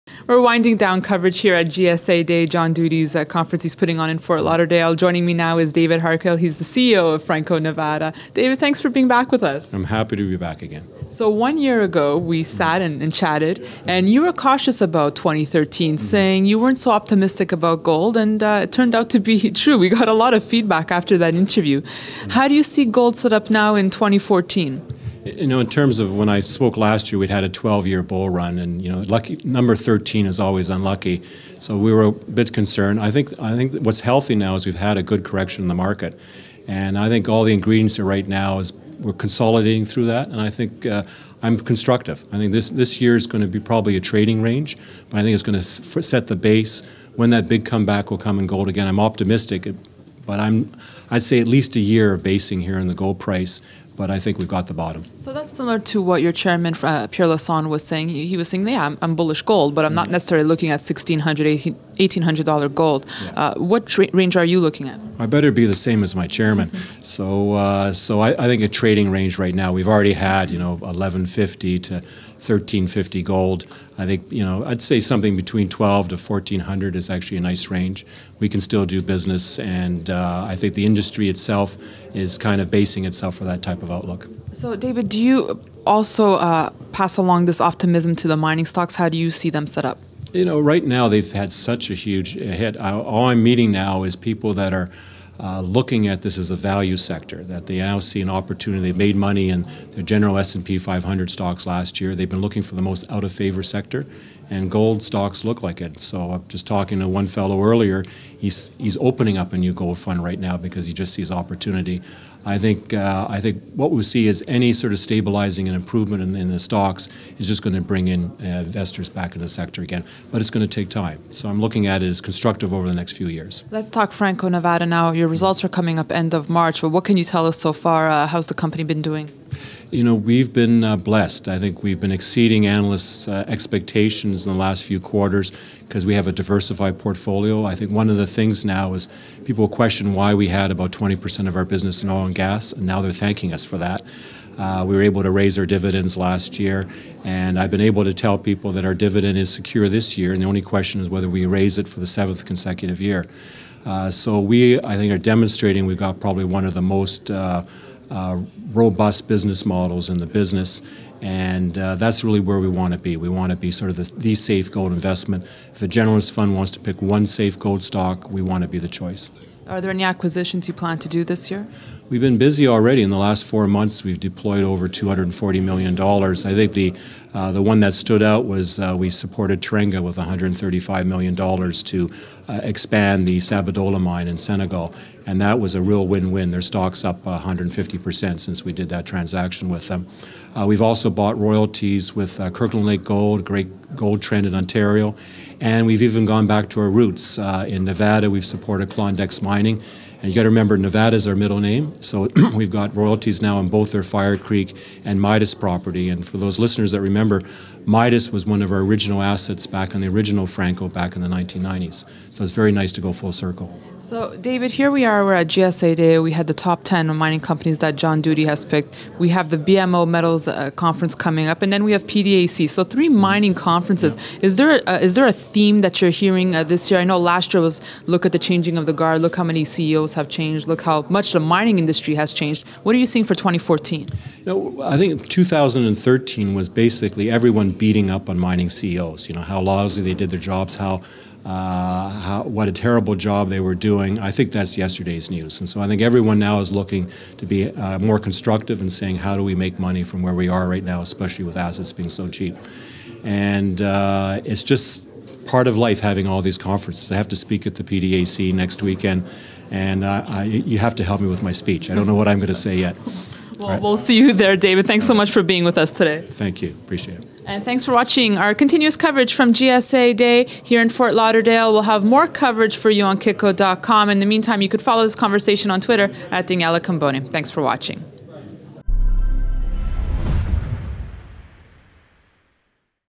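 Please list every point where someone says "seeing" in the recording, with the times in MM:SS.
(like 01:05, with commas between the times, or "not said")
03:53.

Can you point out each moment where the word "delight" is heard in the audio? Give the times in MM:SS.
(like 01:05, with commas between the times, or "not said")
not said.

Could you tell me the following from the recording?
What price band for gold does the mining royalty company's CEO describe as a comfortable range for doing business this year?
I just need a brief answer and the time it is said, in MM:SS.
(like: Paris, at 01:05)
1200 to 1400, at 01:15.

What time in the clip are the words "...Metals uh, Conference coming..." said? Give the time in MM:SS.
03:40.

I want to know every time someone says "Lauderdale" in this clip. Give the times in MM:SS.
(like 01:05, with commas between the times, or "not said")
00:04, 04:31.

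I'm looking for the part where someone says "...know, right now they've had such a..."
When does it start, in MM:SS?
01:30.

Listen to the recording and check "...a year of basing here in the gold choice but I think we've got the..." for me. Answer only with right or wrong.
wrong.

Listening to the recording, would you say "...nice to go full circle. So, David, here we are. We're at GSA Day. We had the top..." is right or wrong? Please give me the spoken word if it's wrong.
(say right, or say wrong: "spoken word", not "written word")
right.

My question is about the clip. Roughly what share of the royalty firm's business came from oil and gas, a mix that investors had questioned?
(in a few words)
20%.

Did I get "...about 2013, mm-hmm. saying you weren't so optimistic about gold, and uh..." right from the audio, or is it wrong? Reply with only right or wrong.
right.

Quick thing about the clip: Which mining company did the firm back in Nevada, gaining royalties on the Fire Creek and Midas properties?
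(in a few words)
Klondex Mining.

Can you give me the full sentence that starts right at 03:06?
Their stock's up 150% uh, since we did that transaction with them.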